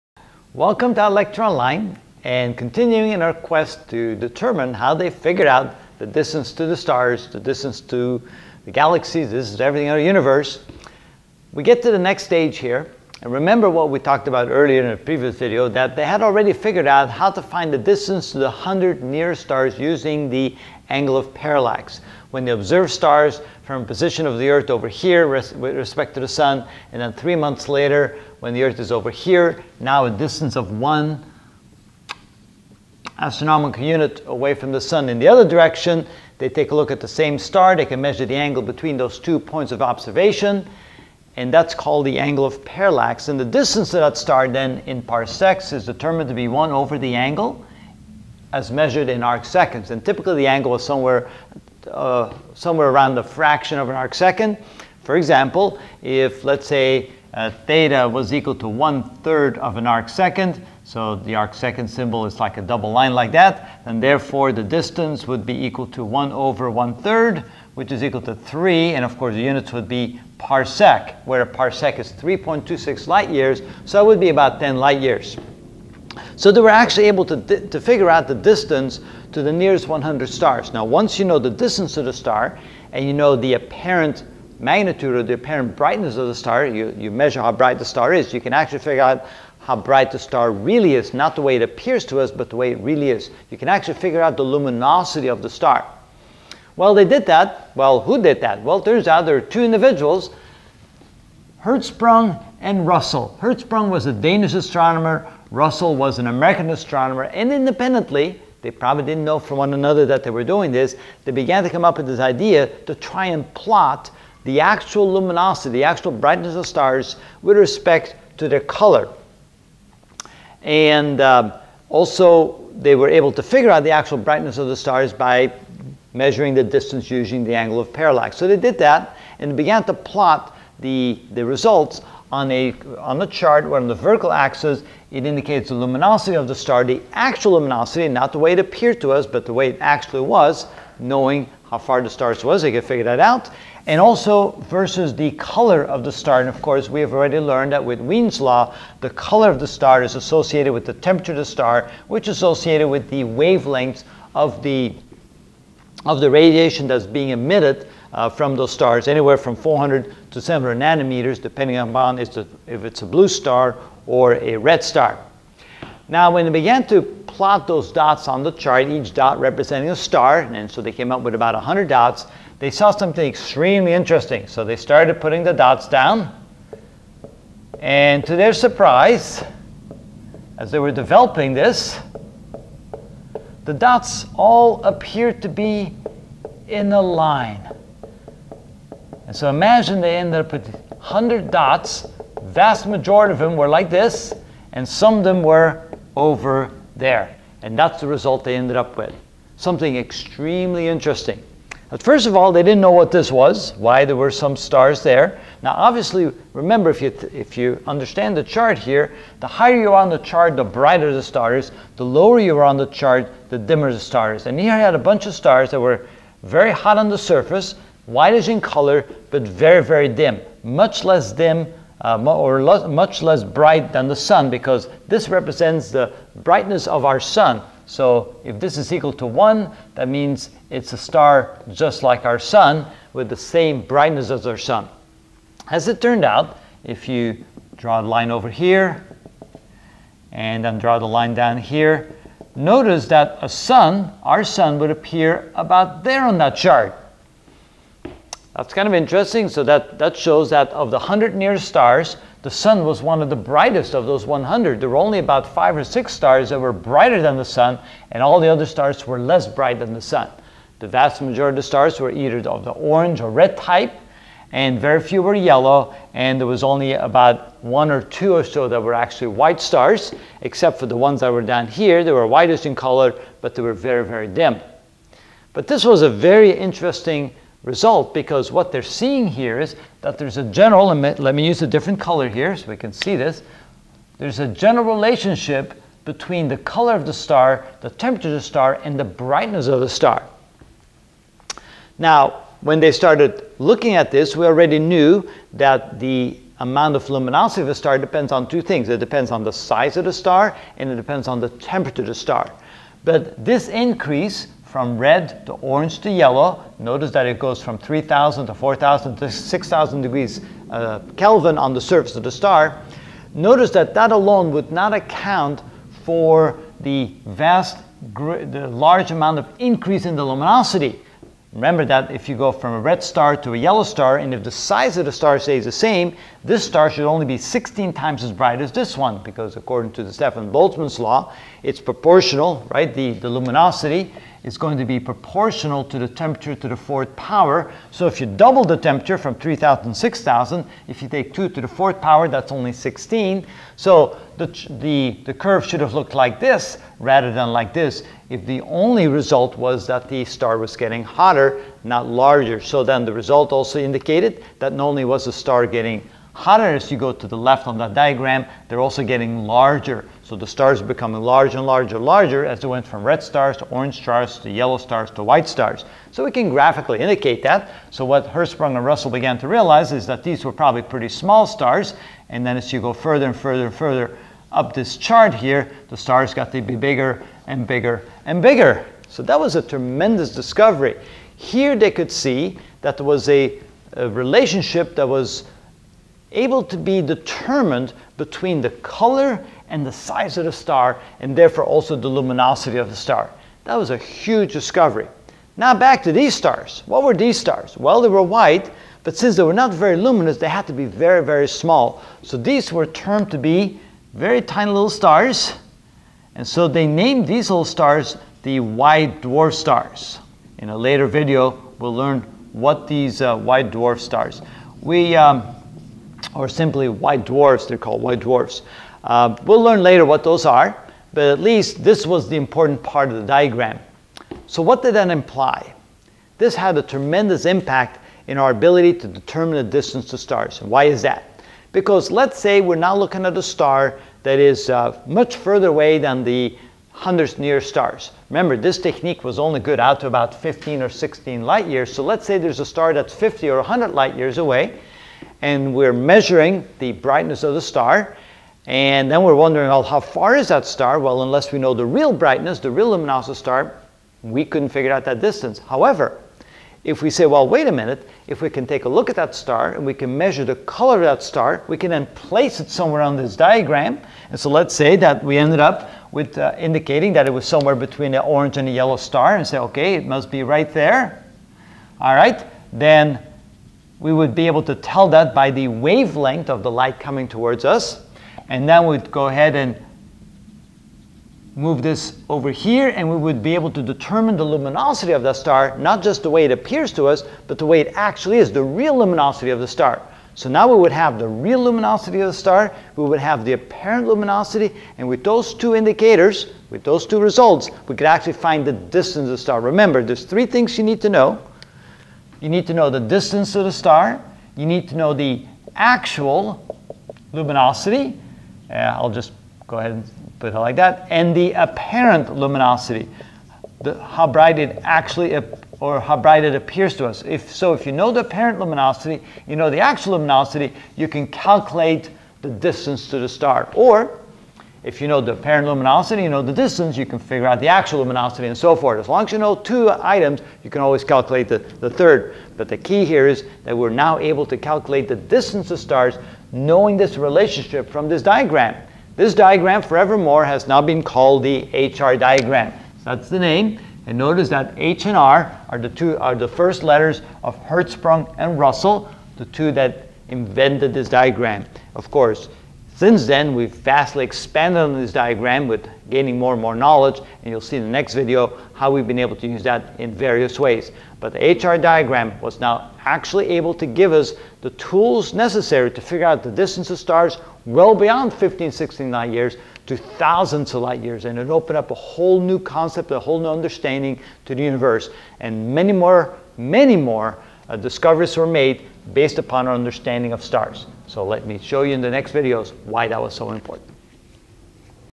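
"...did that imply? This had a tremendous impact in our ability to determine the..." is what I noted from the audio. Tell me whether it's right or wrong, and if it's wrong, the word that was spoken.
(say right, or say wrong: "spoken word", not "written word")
right.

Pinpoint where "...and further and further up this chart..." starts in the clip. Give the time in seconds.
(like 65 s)
373 s.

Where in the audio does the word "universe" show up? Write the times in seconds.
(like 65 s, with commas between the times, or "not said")
10 s, 574 s.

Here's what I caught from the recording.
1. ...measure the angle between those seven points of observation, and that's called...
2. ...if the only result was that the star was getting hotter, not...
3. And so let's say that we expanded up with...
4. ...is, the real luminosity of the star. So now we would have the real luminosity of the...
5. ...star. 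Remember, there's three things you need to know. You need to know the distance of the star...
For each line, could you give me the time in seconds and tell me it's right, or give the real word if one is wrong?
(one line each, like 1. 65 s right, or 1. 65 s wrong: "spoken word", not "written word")
1. 38 s wrong: "two", not "seven"
2. 348 s right
3. 464 s wrong: "ended", not "expanded"
4. 488 s right
5. 499 s right.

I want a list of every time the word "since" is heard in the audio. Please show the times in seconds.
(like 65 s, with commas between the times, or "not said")
399 s, 553 s.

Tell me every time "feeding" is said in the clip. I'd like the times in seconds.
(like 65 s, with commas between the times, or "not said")
not said.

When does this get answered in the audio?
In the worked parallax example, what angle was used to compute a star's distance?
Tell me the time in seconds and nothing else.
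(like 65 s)
58 s.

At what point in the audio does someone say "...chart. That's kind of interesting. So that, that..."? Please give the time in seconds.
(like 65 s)
246 s.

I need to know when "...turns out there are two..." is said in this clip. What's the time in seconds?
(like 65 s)
98 s.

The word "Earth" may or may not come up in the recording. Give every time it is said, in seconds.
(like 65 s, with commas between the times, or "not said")
24 s, 28 s.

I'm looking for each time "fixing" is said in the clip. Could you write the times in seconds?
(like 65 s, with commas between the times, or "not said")
not said.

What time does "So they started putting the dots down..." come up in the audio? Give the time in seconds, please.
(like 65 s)
174 s.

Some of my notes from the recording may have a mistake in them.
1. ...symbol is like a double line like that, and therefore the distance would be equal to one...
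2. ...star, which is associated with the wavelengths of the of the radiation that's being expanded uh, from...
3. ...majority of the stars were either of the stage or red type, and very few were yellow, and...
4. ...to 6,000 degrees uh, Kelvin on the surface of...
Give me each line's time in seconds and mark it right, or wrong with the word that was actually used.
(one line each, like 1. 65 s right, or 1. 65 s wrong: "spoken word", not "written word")
1. 61 s right
2. 151 s wrong: "emitted", not "expanded"
3. 261 s wrong: "orange", not "stage"
4. 309 s right.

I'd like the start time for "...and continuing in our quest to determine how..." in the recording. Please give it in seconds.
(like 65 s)
2 s.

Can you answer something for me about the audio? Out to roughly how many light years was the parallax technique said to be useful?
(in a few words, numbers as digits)
15 or 16.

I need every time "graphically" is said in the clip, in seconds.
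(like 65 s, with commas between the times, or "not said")
366 s.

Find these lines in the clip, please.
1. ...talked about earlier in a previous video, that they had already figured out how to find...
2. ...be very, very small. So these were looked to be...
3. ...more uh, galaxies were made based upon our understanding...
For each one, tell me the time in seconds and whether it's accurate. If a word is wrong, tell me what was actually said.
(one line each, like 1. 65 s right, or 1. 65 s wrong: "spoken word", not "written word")
1. 13 s right
2. 400 s wrong: "termed", not "looked"
3. 576 s wrong: "discoveries", not "galaxies".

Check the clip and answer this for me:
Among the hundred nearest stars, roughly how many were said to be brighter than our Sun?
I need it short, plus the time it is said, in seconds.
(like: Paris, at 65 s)
5 or 6, at 255 s.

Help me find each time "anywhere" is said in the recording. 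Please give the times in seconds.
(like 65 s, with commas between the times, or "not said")
159 s.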